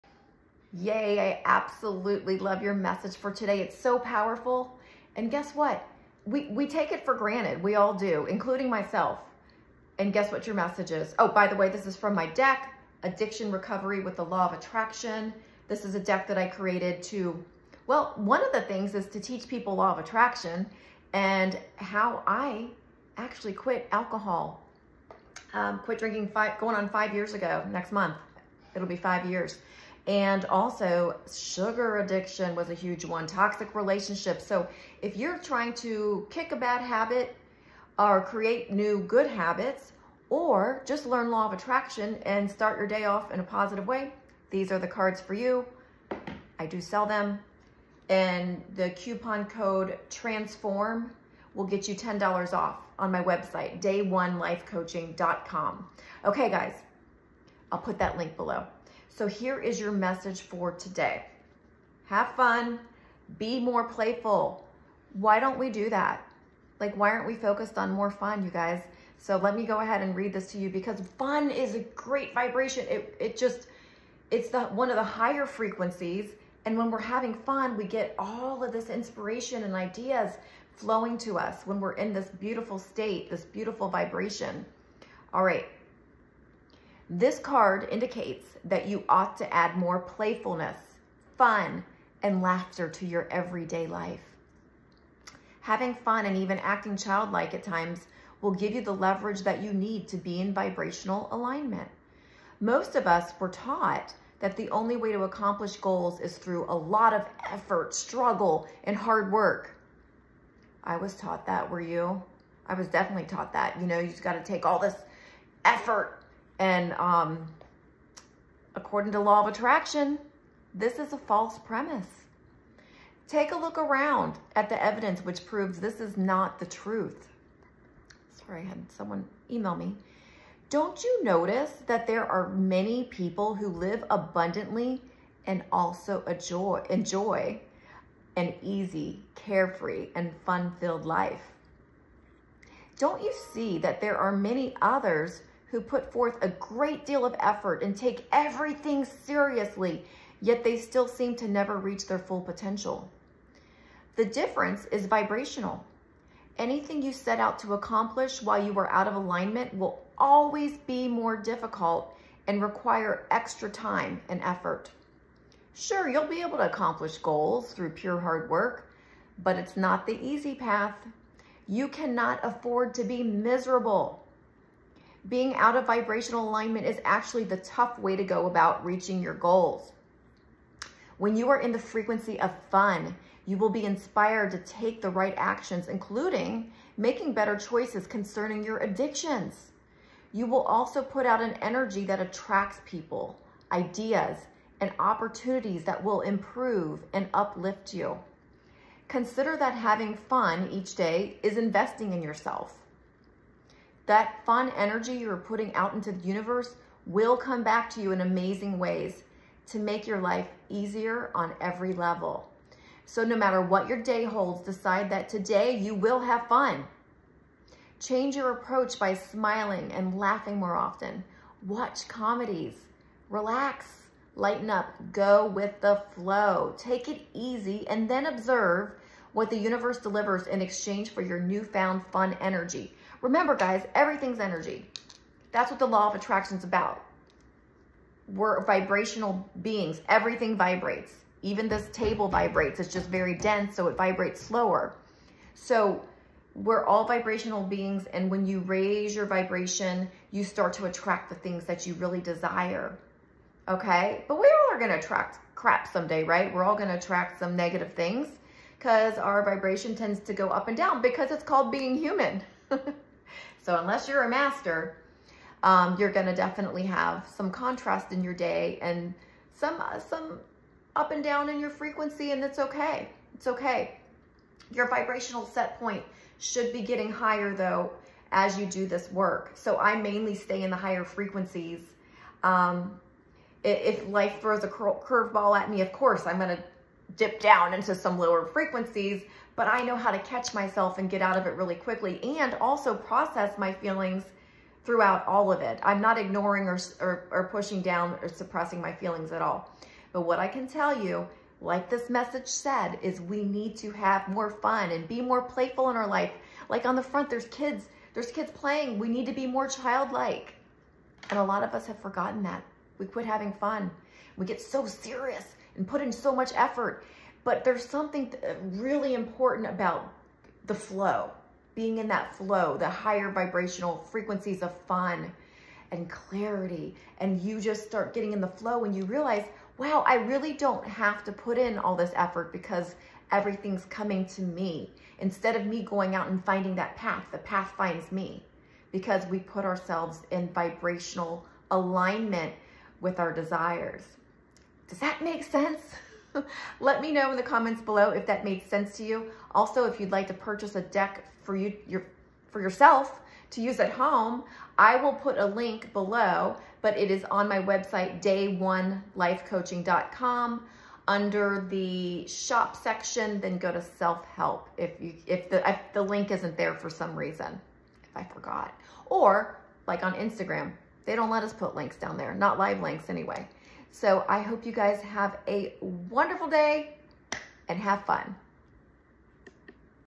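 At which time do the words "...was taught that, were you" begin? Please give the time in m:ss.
1:50.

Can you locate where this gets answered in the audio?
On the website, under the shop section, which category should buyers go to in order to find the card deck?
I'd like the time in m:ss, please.
6:03.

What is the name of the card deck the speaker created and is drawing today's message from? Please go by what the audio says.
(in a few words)
Addiction Recovery with the Law of Attraction.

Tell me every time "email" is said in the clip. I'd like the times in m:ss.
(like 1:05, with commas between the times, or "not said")
2:09.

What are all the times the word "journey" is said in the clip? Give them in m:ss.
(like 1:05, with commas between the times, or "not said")
not said.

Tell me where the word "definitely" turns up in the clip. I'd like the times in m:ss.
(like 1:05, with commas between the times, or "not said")
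1:52, 4:26.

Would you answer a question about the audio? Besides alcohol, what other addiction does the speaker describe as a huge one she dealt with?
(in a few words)
Sugar addiction.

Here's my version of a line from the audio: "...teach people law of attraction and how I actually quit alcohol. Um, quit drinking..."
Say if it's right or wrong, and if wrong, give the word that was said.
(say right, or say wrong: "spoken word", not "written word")
right.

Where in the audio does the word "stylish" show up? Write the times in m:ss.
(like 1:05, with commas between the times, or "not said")
not said.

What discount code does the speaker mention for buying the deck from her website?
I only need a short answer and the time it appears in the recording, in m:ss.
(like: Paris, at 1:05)
TRANSFORM, at 0:50.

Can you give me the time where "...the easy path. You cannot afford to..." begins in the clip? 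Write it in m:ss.
2:50.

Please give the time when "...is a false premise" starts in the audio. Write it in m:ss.
2:00.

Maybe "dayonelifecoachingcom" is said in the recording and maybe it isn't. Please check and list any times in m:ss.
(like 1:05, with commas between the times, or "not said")
0:53, 5:58.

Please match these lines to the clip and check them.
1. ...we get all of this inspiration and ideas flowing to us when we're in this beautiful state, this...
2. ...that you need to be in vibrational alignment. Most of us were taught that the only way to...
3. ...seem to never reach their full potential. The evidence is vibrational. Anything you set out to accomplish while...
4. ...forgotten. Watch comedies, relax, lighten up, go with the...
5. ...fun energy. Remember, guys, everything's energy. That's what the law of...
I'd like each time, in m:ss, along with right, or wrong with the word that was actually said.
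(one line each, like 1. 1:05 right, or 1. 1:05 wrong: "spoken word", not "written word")
1. 1:17 right
2. 1:39 right
3. 2:31 wrong: "difference", not "evidence"
4. 3:40 wrong: "often", not "forgotten"
5. 3:52 right.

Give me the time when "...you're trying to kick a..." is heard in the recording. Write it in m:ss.
0:35.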